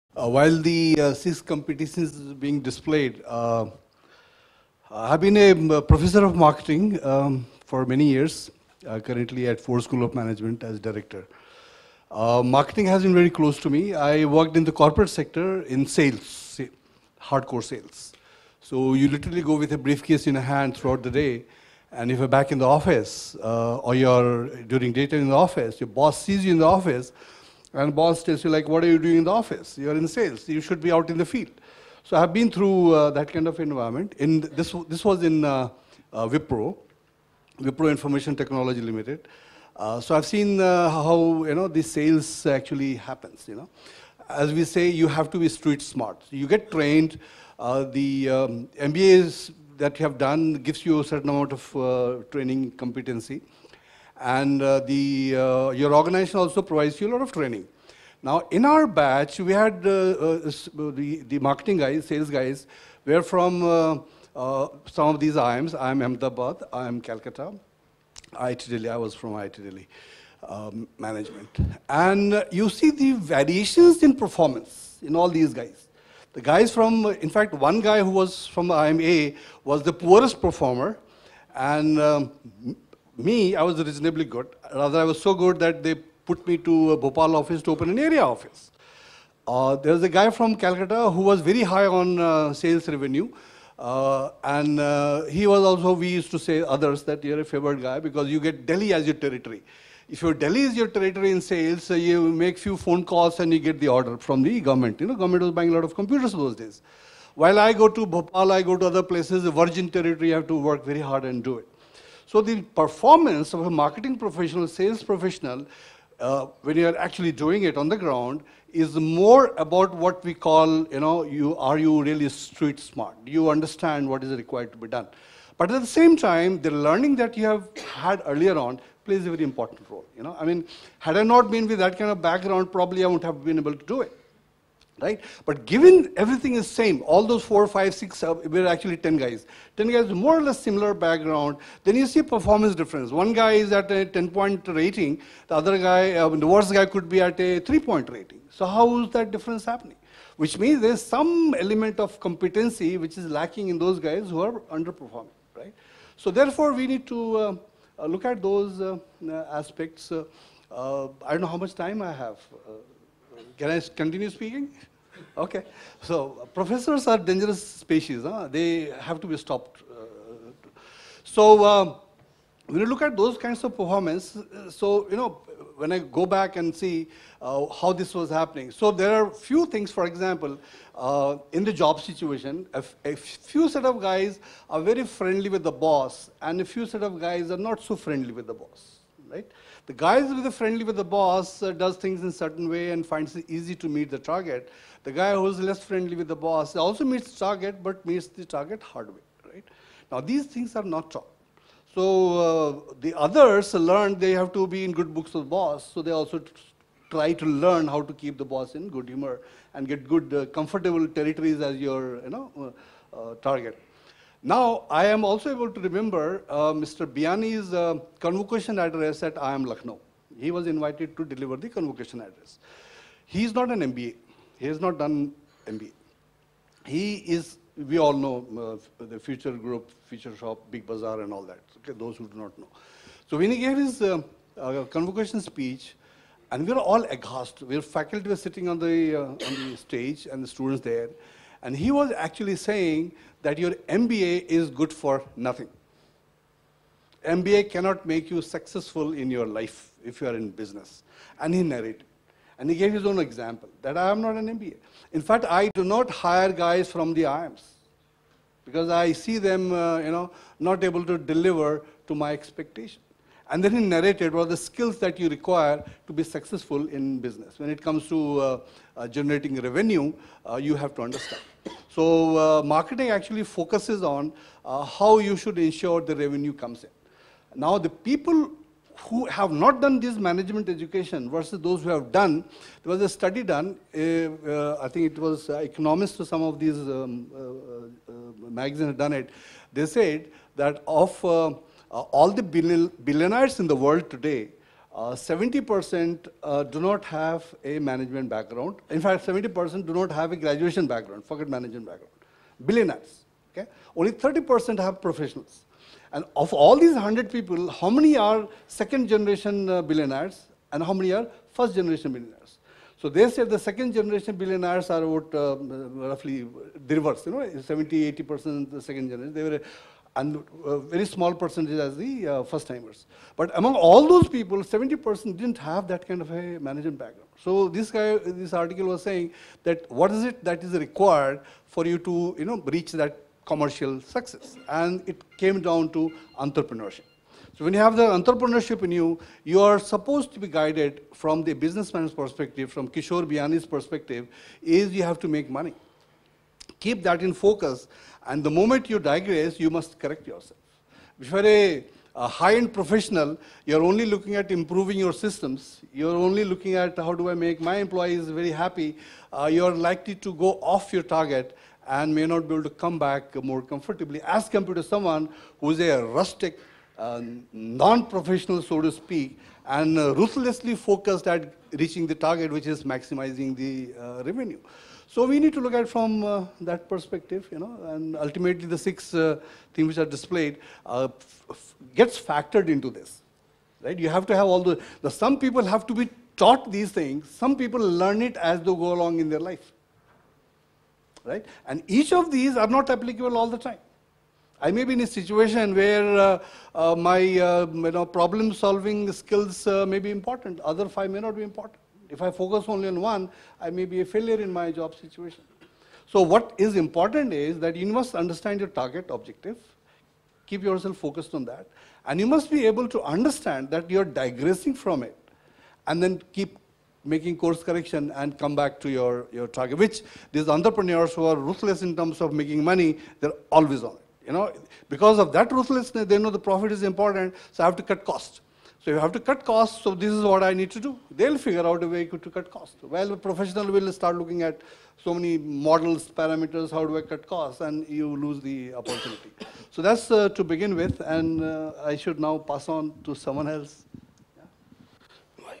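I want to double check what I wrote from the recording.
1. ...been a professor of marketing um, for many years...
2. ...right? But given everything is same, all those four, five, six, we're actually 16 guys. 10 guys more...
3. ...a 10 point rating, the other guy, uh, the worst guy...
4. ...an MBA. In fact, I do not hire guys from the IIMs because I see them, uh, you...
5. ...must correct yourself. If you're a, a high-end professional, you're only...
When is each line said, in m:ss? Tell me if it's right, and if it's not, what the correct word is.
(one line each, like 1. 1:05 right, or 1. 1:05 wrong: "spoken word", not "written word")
1. 0:05 right
2. 2:14 wrong: "10", not "16"
3. 2:23 right
4. 4:14 right
5. 5:49 right.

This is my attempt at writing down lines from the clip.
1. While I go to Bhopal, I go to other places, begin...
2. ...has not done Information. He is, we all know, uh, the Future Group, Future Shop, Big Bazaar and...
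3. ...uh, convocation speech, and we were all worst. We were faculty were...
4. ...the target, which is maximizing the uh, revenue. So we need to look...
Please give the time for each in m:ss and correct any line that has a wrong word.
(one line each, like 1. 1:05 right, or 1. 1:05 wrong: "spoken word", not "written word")
1. 1:47 wrong: "virgin", not "begin"
2. 3:44 wrong: "MBA", not "Information"
3. 3:54 wrong: "aghast", not "worst"
4. 6:12 right.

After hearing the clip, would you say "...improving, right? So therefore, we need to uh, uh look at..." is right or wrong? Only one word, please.
wrong.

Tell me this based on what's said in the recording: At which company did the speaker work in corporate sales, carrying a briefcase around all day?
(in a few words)
Wipro Information Technology Limited.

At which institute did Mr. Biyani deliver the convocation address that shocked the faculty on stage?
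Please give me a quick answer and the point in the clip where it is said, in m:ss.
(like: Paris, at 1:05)
IIM Lucknow, at 3:39.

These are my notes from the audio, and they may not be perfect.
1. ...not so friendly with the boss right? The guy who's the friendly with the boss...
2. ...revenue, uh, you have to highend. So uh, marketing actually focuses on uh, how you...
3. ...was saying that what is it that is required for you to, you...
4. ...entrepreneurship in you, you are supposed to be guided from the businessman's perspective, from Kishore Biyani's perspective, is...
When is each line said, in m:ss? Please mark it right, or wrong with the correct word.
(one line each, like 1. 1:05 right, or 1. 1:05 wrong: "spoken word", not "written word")
1. 3:07 right
2. 4:29 wrong: "understand", not "highend"
3. 5:28 right
4. 5:38 right.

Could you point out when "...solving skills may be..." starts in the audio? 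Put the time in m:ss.
6:38.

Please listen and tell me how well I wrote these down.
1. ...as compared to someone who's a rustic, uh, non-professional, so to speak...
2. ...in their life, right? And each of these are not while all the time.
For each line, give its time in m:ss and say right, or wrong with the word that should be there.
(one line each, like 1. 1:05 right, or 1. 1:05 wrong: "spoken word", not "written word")
1. 6:04 right
2. 6:29 wrong: "applicable", not "while".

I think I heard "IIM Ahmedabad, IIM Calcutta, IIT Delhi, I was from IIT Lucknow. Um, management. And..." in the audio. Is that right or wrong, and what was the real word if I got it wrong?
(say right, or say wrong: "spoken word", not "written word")
wrong: "Delhi", not "Lucknow".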